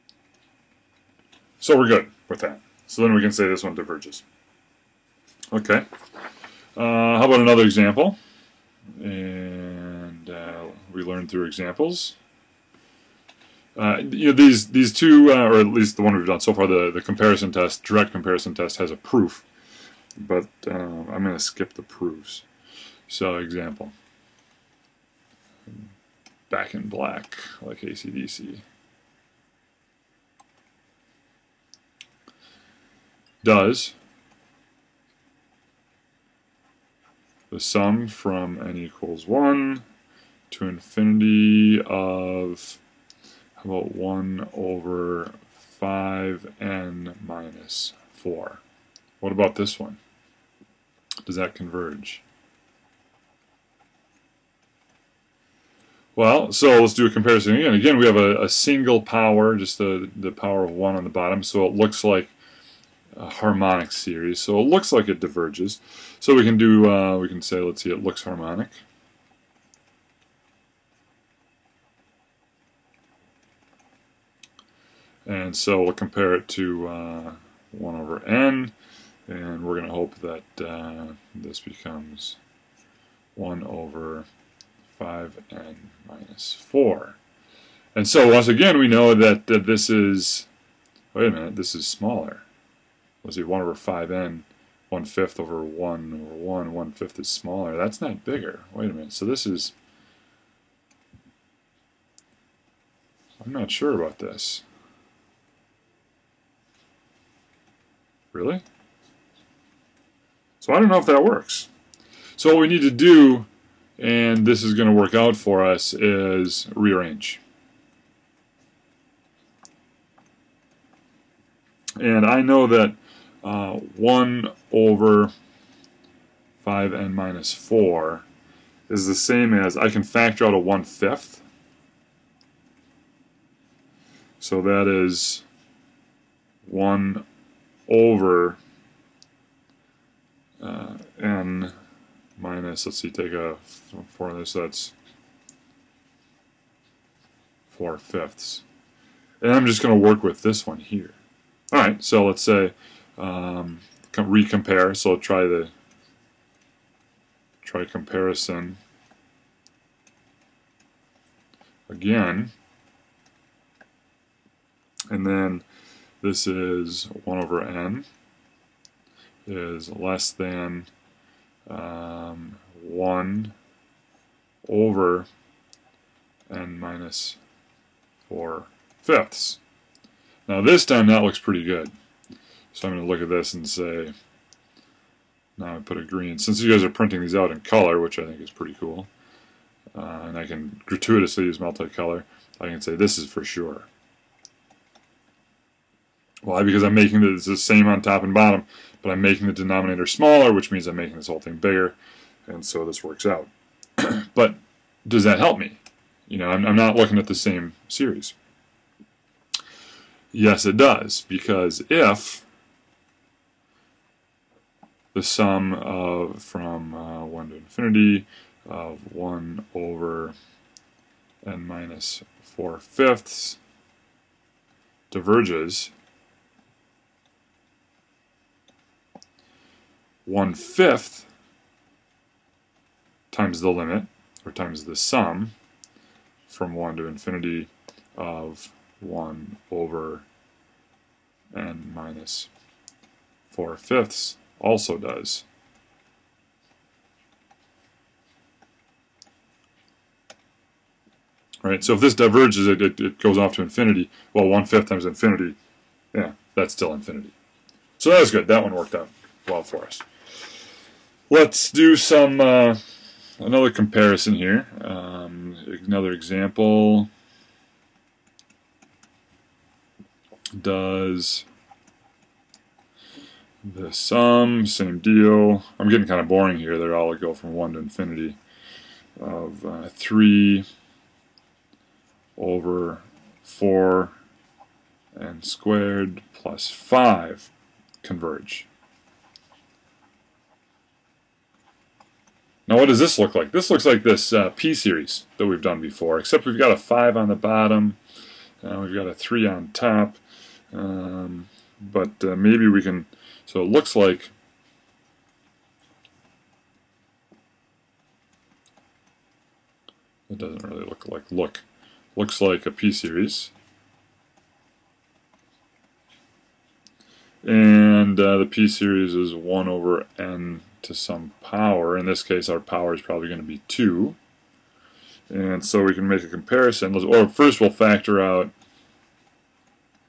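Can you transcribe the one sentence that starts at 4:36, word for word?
They're all go from 1 to infinity of uh, 3 over 4 and squared plus 5 converge.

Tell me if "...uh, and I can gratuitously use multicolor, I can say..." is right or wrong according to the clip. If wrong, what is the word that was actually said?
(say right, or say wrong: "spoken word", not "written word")
right.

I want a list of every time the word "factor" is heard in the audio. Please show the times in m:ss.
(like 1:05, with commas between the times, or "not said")
2:10, 5:27.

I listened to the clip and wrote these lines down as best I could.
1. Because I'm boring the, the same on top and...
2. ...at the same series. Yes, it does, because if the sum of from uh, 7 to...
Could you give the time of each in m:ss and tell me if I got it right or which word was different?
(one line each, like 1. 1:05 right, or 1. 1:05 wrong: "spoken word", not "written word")
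1. 3:16 wrong: "making", not "boring"
2. 3:27 wrong: "1", not "7".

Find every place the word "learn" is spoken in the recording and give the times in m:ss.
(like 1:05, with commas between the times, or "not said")
0:11.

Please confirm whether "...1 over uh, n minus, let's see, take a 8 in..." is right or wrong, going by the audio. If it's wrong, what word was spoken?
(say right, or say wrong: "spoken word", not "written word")
wrong: "4", not "8".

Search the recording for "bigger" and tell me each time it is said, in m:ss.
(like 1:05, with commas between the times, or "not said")
1:38, 3:21.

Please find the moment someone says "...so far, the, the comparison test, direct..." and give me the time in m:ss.
0:16.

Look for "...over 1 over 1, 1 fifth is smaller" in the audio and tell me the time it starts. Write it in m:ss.
1:35.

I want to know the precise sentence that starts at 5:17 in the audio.
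And uh, the P series is 1 over N to some power.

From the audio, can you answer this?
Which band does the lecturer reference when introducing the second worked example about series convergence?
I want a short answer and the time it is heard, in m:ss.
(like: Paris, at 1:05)
AC/DC, at 0:27.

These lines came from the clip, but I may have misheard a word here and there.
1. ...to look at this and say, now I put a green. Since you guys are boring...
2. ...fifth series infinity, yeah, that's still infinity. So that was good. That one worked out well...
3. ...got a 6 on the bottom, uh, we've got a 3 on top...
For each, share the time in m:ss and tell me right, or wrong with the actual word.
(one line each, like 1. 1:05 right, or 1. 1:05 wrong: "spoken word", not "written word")
1. 3:03 wrong: "printing", not "boring"
2. 4:14 wrong: "times", not "series"
3. 4:56 wrong: "5", not "6".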